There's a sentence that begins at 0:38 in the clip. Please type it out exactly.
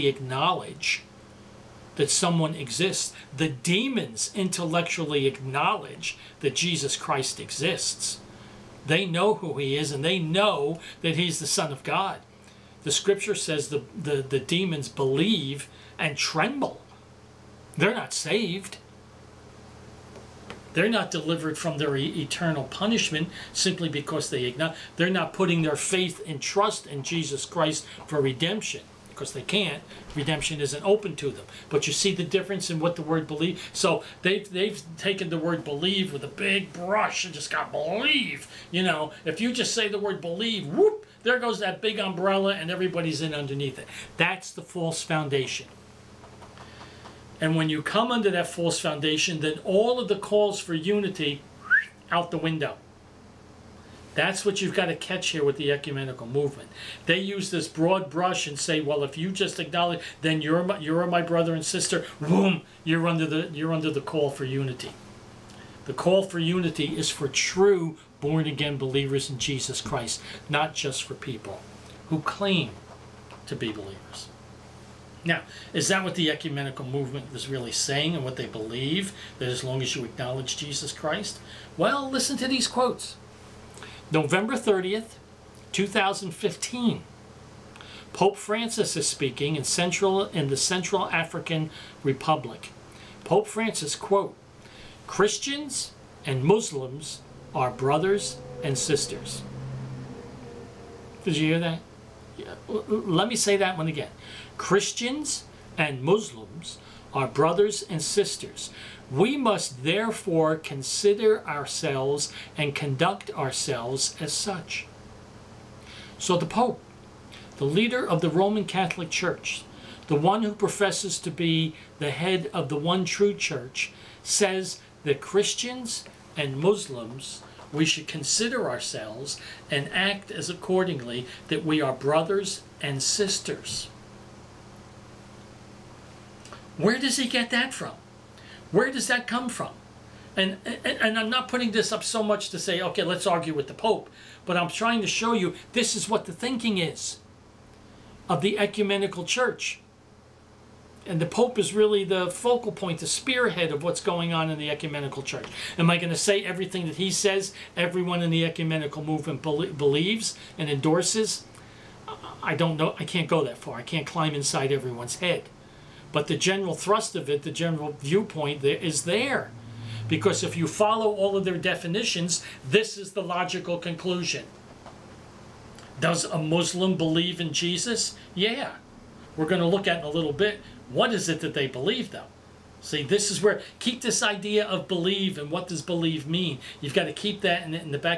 You know, if you just say the word believe, whoop, there goes that big umbrella and everybody's in underneath it.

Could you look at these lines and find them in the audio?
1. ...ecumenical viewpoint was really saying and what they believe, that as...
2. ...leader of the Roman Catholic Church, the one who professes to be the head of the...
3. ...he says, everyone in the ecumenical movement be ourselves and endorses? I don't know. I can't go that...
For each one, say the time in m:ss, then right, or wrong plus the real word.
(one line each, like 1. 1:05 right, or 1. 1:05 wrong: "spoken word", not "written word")
1. 1:16 wrong: "movement", not "viewpoint"
2. 1:57 right
3. 2:36 wrong: "believes", not "ourselves".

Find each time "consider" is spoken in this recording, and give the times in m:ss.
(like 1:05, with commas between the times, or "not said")
1:50, 2:08.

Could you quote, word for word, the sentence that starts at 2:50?
Because if you follow all of their definitions, this is the logical conclusion.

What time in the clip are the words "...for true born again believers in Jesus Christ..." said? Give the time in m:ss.
1:07.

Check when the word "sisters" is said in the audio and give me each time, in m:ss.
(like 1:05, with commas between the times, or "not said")
1:01, 1:38, 1:48, 2:13.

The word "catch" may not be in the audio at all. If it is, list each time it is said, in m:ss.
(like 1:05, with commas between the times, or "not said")
0:54.